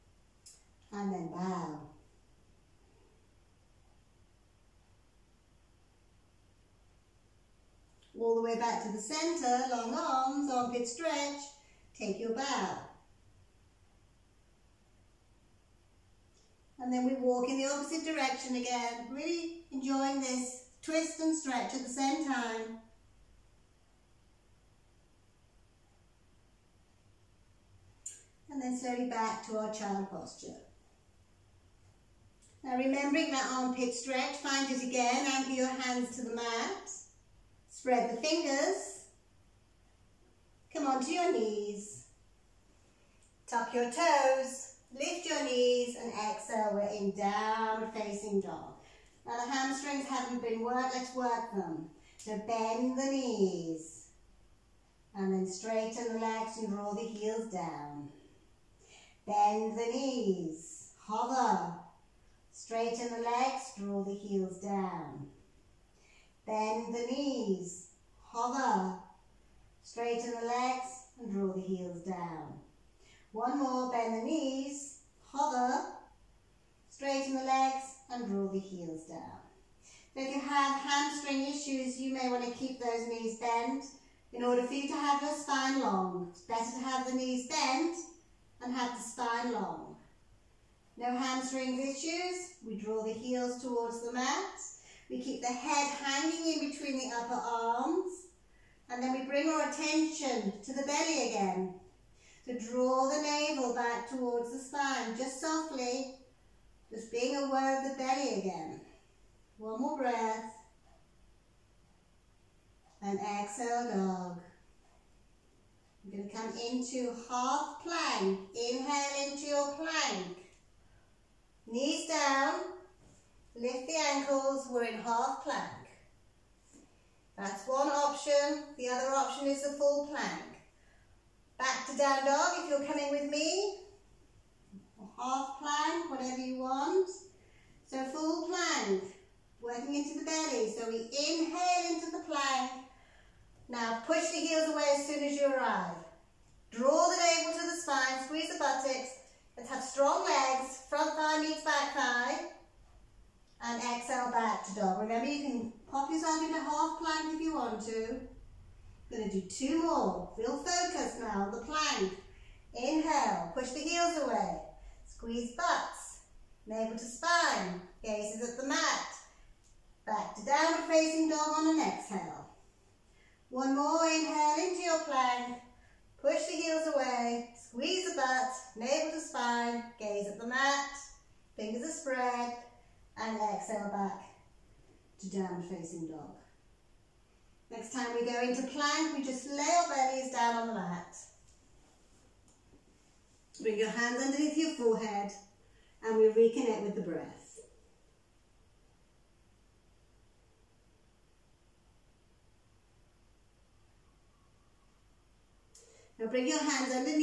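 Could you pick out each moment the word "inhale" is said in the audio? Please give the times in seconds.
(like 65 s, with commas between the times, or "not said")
118 s, 141 s, 162 s, 174 s.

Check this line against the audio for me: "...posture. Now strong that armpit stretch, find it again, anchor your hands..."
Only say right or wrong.
wrong.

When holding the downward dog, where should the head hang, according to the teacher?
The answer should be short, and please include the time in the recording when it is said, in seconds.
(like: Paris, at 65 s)
Between the upper arms, at 96 s.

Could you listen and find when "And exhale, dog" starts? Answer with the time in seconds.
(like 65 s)
113 s.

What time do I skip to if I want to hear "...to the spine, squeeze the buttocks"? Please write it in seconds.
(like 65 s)
147 s.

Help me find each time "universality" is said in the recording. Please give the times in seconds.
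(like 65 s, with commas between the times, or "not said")
not said.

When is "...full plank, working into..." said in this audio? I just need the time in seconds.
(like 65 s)
138 s.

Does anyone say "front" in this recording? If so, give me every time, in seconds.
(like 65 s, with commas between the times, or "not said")
150 s.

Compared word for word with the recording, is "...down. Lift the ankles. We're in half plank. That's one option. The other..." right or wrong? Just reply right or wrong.
right.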